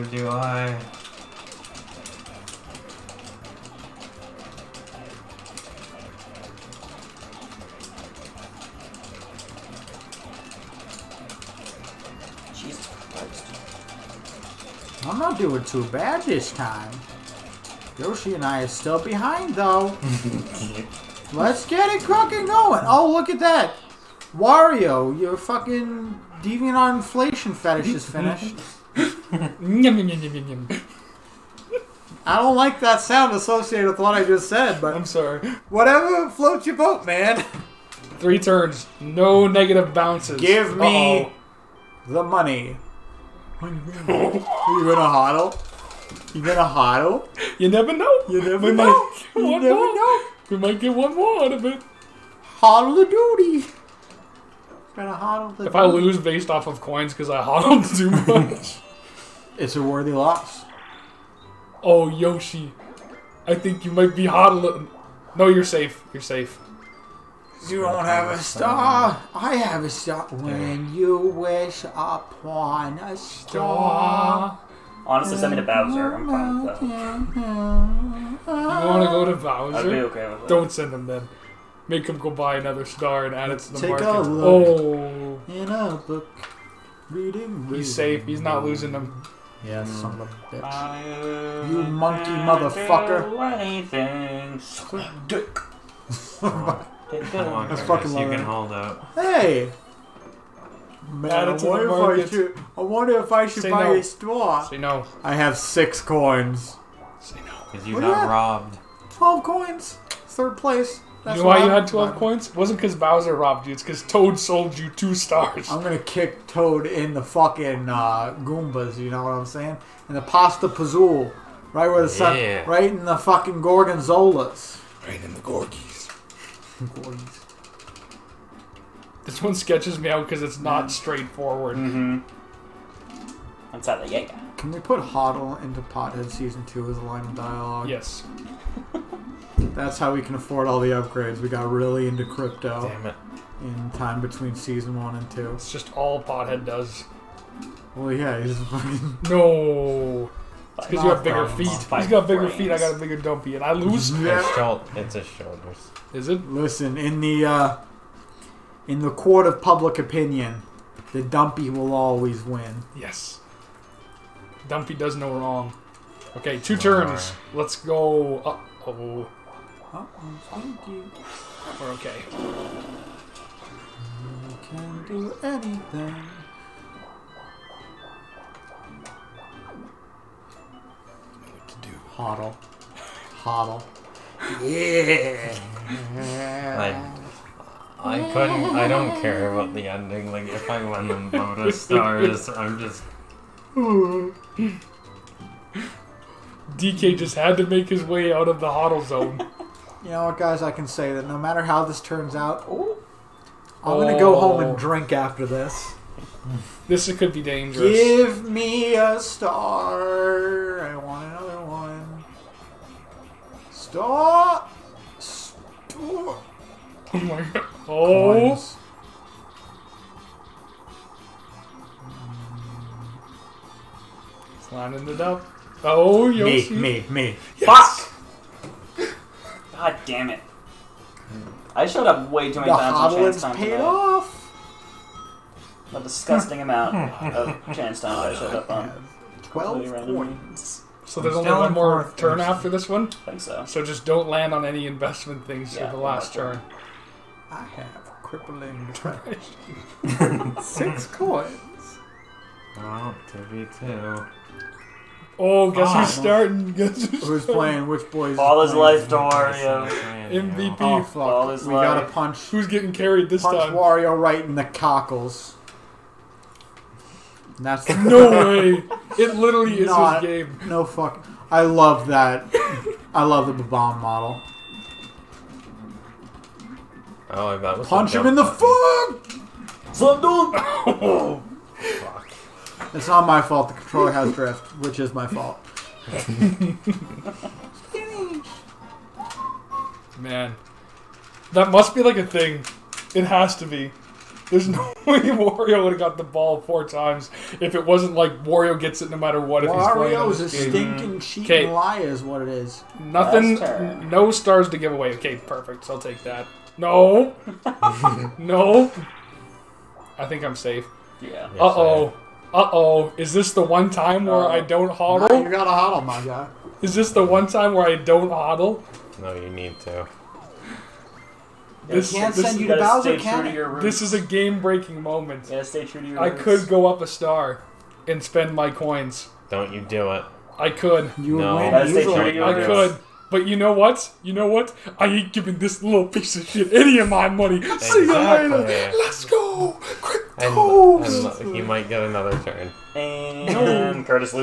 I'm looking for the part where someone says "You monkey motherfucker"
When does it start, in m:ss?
1:31.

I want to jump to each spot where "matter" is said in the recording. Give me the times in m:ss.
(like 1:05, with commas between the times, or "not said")
3:21, 4:59.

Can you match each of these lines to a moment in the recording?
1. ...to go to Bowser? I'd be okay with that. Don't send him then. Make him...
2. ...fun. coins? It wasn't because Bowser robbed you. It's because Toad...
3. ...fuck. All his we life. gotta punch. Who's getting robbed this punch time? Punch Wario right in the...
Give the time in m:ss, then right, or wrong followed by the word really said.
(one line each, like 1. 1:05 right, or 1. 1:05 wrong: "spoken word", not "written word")
1. 1:19 right
2. 1:52 right
3. 4:21 wrong: "carried", not "robbed".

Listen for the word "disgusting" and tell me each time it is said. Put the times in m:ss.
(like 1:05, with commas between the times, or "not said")
3:55.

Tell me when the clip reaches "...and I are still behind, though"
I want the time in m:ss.
0:18.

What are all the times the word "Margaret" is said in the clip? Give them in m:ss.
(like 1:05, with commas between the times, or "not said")
not said.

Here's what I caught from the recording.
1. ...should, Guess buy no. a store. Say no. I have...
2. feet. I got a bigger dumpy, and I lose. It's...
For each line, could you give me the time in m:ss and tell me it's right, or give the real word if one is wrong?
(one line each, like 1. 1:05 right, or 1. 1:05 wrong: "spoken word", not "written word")
1. 1:43 wrong: "Say", not "Guess"
2. 2:32 right.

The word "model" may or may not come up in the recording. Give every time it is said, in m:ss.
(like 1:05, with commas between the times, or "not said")
4:34.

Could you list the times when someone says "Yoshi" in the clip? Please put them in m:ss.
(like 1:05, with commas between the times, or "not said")
0:17, 1:02, 3:46.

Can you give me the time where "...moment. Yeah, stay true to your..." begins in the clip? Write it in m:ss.
5:25.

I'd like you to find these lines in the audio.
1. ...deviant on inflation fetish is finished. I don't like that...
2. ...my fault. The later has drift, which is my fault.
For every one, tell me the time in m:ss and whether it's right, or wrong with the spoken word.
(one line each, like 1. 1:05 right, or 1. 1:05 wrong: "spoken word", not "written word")
1. 0:26 right
2. 4:43 wrong: "controller", not "later".